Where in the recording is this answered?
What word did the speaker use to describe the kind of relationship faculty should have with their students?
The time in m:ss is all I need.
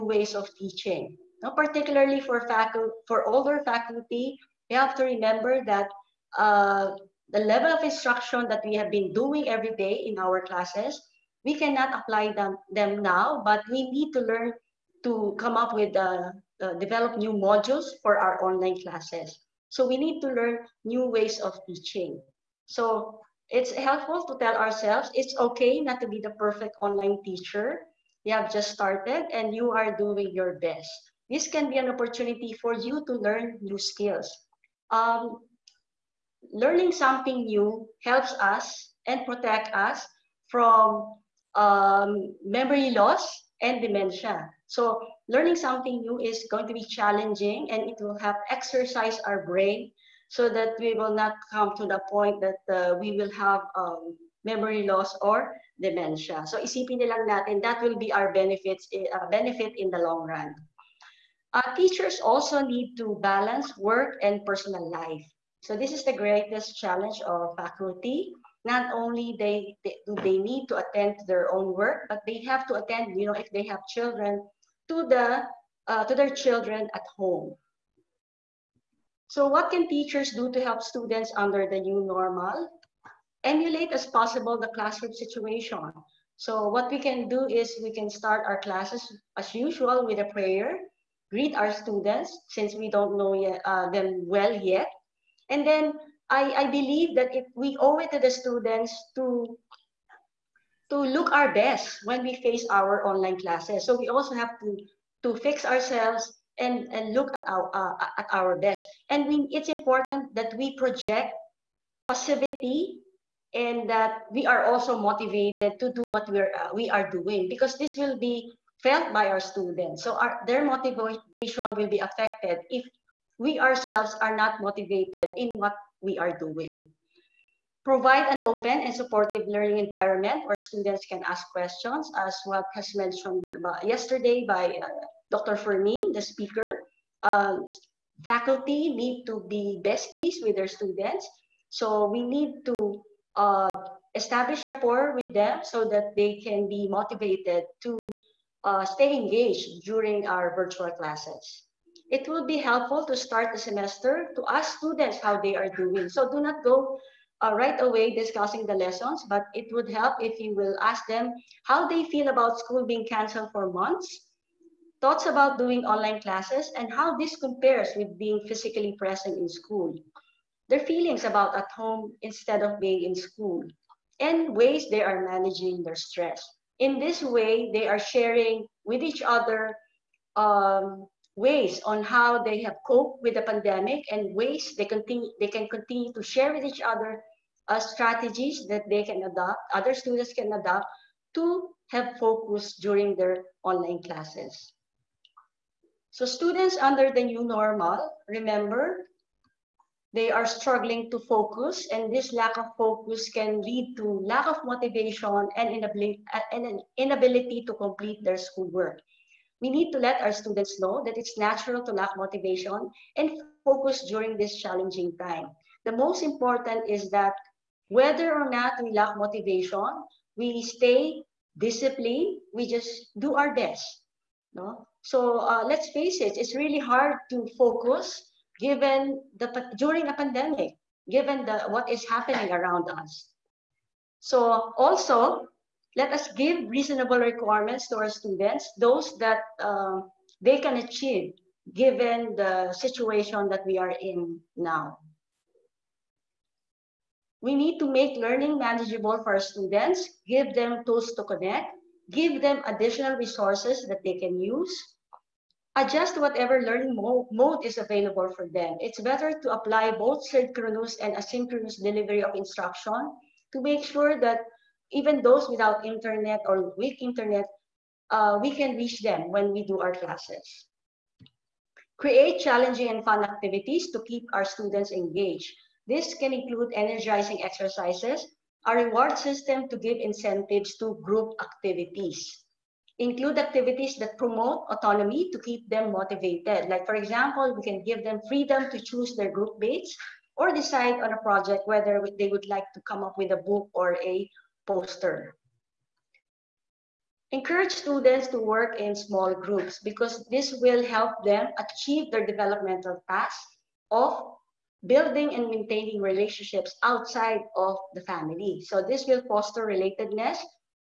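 2:19.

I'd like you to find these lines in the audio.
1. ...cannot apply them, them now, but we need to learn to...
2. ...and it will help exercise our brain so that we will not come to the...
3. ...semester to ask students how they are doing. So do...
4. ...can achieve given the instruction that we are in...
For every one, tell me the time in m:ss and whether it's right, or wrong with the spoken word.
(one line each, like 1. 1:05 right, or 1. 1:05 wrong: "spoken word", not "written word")
1. 0:11 right
2. 0:47 right
3. 2:33 right
4. 4:00 wrong: "situation", not "instruction".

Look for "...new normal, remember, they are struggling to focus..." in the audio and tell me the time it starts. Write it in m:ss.
3:17.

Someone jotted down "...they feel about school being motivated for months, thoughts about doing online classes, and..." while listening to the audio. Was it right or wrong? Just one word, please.
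wrong.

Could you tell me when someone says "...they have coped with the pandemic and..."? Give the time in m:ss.
3:02.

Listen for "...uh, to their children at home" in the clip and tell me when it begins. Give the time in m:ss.
1:15.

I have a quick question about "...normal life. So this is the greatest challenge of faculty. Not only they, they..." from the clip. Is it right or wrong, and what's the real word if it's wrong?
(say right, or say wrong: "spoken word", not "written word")
wrong: "personal", not "normal".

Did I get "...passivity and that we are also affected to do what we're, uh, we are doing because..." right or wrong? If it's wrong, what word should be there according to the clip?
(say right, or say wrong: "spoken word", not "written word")
wrong: "motivated", not "affected".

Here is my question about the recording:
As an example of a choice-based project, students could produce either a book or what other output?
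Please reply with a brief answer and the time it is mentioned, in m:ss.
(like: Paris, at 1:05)
a poster, at 4:54.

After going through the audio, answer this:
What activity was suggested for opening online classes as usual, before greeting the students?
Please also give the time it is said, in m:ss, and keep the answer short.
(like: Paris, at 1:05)
a prayer, at 1:30.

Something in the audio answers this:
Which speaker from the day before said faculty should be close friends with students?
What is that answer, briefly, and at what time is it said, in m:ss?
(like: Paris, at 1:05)
Dr. Fermin, at 2:15.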